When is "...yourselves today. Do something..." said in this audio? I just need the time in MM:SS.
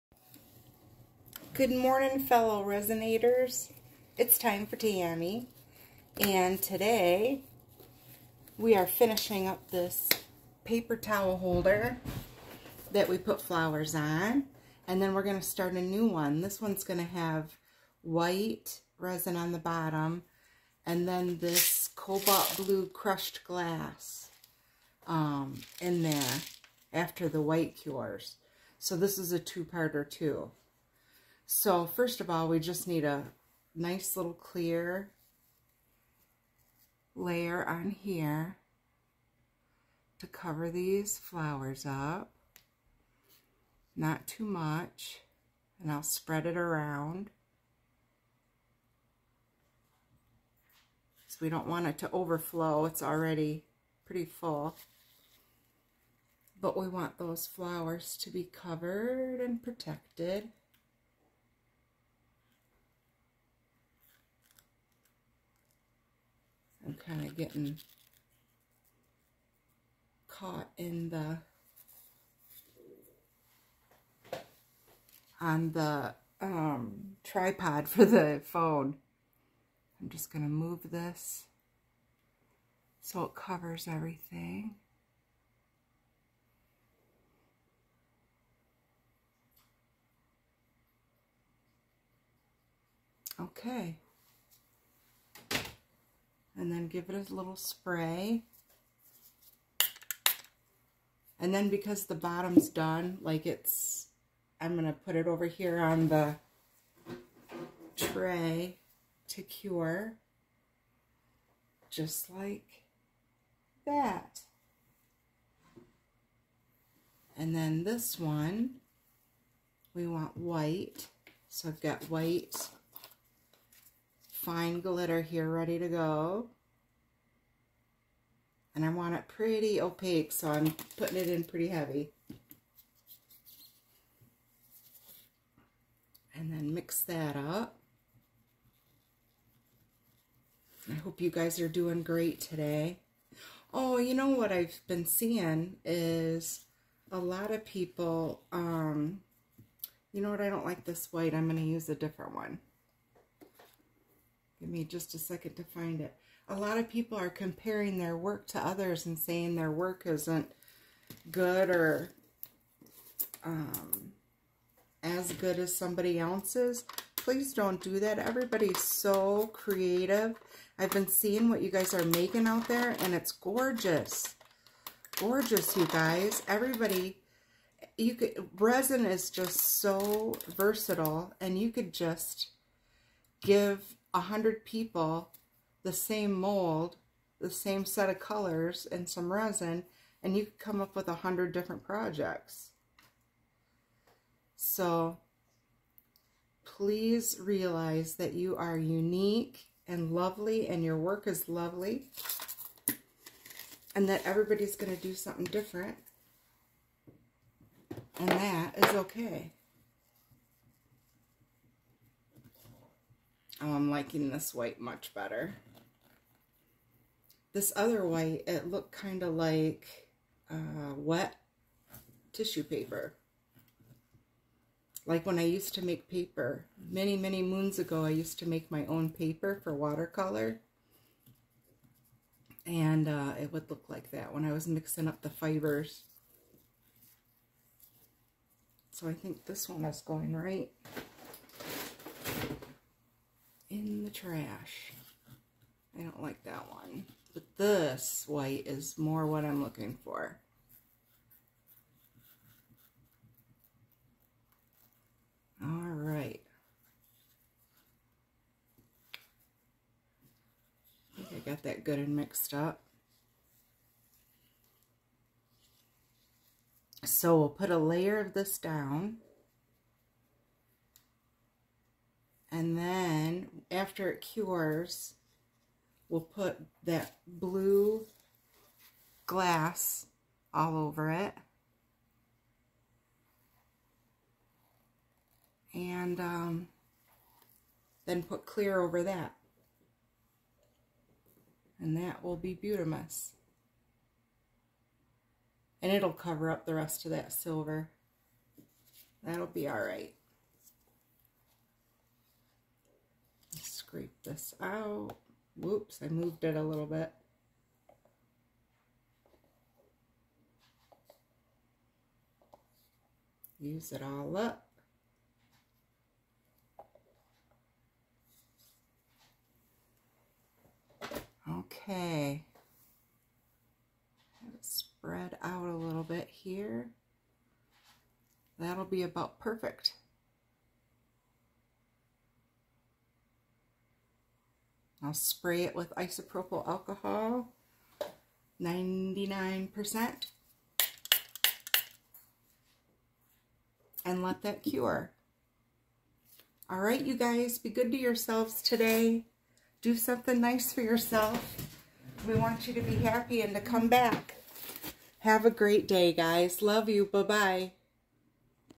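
05:47.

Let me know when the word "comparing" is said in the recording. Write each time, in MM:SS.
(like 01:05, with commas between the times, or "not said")
02:37.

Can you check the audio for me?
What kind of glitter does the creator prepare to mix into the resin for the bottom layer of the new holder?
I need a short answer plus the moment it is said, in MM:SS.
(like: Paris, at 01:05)
white fine glitter, at 02:02.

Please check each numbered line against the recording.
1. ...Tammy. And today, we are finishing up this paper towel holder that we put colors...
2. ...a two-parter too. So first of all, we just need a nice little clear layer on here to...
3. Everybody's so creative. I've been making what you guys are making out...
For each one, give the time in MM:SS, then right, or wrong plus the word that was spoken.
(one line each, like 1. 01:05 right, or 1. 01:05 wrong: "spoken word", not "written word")
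1. 00:04 wrong: "flowers", not "colors"
2. 00:29 right
3. 02:48 wrong: "seeing", not "making".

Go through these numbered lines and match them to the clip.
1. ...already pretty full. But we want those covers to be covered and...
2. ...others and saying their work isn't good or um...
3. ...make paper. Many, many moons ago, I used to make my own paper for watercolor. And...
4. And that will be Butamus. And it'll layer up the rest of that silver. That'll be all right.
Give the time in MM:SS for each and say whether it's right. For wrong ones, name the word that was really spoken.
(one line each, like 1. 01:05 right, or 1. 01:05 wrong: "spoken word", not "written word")
1. 00:53 wrong: "flowers", not "covers"
2. 02:38 right
3. 03:45 right
4. 04:51 wrong: "cover", not "layer".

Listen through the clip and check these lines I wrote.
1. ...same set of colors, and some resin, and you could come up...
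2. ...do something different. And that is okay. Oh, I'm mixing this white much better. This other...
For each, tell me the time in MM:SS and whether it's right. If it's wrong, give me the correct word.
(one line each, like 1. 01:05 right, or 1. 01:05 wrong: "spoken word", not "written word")
1. 03:07 right
2. 03:25 wrong: "liking", not "mixing".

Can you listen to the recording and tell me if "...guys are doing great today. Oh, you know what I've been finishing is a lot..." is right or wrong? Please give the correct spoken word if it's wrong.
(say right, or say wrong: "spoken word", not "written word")
wrong: "seeing", not "finishing".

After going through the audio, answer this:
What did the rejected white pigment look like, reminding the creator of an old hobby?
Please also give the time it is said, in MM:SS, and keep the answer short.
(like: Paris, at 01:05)
wet tissue paper, at 03:40.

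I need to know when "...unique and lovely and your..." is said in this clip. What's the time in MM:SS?
03:18.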